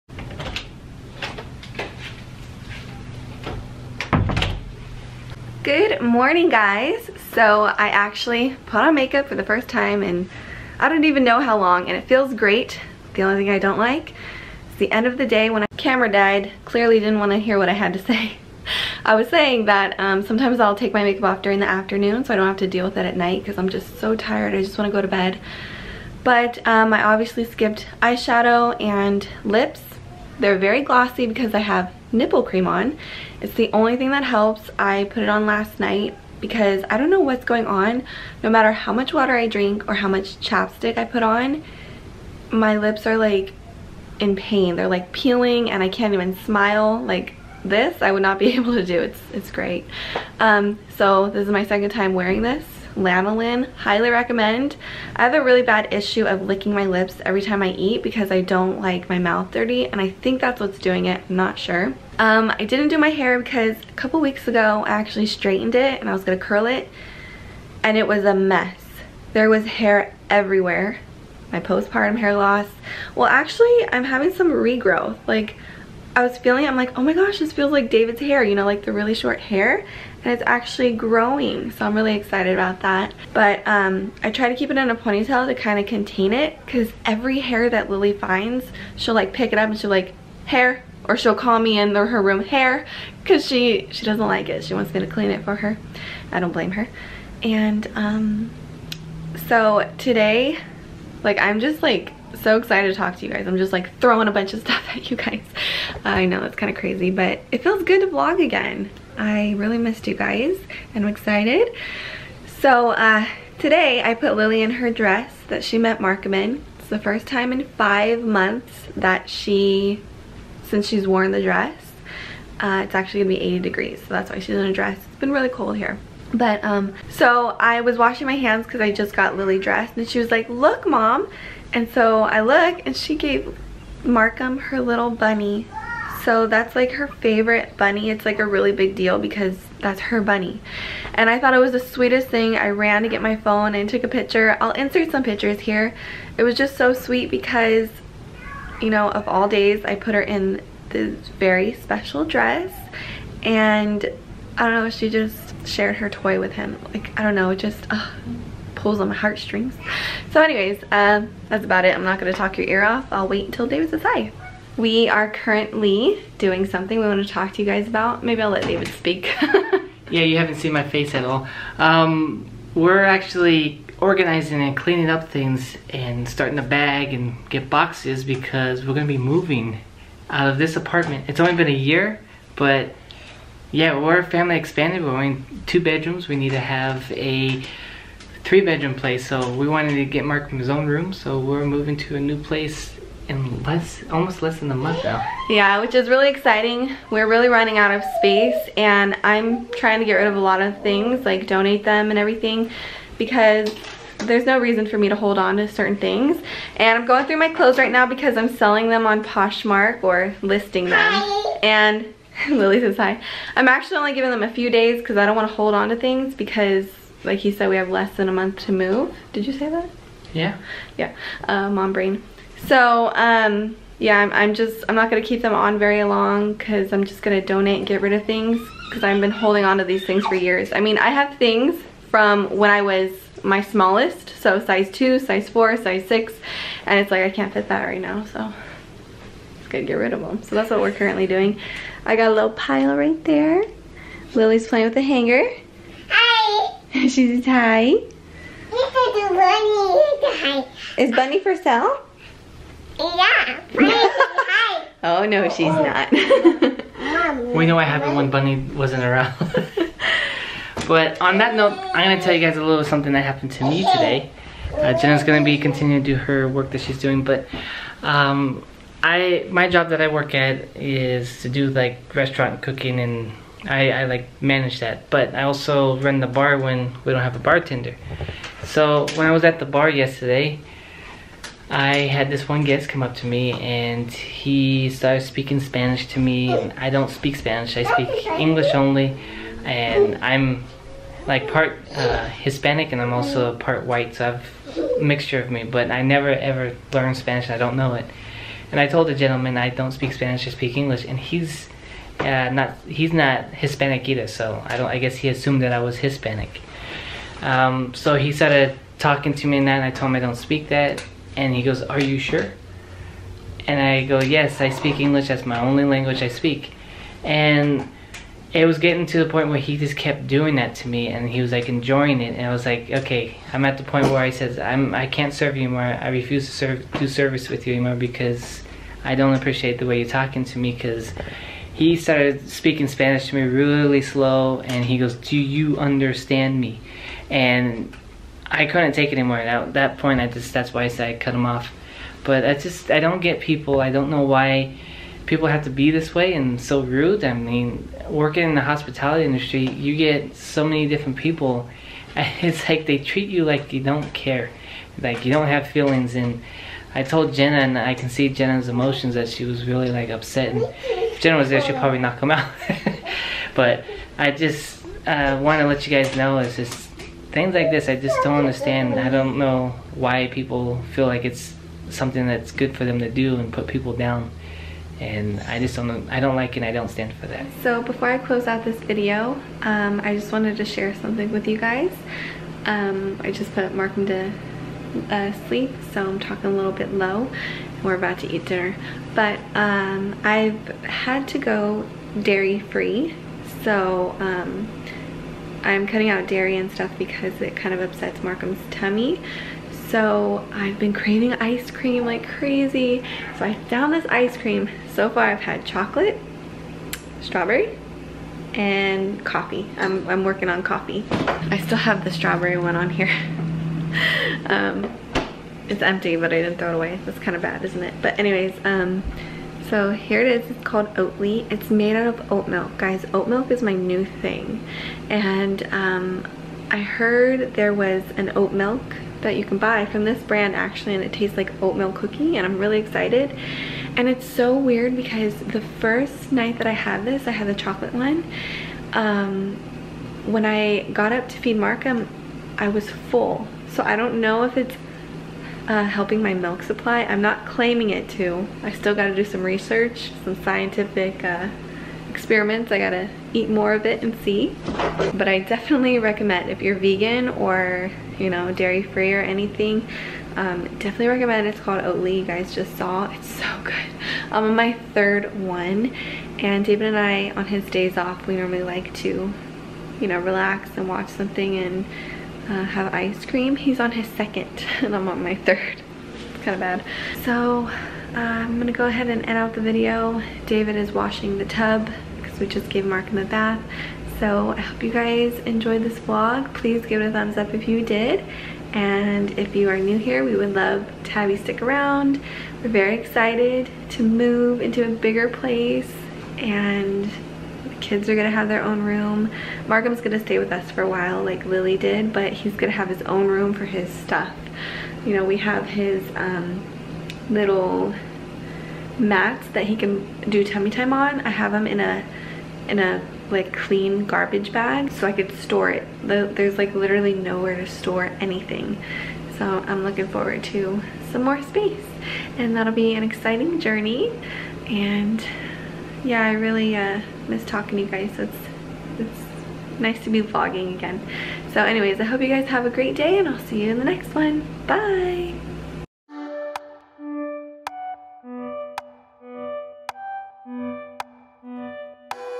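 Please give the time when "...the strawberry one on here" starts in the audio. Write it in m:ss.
6:52.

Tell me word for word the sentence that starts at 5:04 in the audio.
I guess he assumed that I was Hispanic.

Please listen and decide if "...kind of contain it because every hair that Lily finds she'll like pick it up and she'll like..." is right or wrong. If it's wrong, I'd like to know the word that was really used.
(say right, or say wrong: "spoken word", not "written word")
right.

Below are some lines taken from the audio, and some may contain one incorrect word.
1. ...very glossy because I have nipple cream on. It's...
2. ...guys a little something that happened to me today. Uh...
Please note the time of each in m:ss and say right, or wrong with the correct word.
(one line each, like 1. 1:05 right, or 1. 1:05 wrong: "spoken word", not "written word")
1. 0:30 right
2. 4:22 right.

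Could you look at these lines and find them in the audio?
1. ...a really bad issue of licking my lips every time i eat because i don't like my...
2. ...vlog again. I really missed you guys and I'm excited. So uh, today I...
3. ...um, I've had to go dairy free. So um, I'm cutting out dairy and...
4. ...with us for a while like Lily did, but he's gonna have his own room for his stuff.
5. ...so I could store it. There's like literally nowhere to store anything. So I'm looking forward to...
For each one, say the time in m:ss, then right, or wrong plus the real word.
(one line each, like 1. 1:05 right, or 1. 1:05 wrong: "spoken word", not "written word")
1. 0:55 right
2. 1:48 right
3. 6:29 right
4. 8:20 right
5. 8:34 right.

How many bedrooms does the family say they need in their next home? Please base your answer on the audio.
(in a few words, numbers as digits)
3.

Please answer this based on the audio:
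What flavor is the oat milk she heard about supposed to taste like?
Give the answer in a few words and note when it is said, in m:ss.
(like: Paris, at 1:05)
Oatmeal cookie, at 7:11.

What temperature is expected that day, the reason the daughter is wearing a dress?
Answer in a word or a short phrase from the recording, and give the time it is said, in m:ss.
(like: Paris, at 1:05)
80, at 2:03.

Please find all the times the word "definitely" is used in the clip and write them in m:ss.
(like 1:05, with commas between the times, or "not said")
7:35, 7:40.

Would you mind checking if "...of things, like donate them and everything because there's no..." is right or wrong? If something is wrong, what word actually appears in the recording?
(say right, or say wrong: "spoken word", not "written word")
right.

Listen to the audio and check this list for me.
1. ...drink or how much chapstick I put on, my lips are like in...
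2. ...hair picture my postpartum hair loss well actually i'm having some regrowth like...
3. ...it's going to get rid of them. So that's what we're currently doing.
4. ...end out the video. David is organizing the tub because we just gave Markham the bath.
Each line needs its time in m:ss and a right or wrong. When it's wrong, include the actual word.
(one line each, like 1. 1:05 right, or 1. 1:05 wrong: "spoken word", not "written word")
1. 0:39 right
2. 1:09 wrong: "everywhere", not "picture"
3. 3:59 right
4. 7:59 wrong: "washing", not "organizing".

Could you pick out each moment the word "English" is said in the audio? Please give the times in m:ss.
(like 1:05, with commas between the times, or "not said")
4:48, 5:00, 5:14.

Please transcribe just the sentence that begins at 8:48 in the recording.
So it's, it's nice to be vlogging again.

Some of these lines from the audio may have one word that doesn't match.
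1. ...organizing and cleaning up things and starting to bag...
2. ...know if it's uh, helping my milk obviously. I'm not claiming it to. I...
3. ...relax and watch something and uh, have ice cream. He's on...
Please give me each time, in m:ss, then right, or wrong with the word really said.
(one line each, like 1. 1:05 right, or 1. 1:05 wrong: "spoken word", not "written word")
1. 2:53 right
2. 7:24 wrong: "supply", not "obviously"
3. 7:50 right.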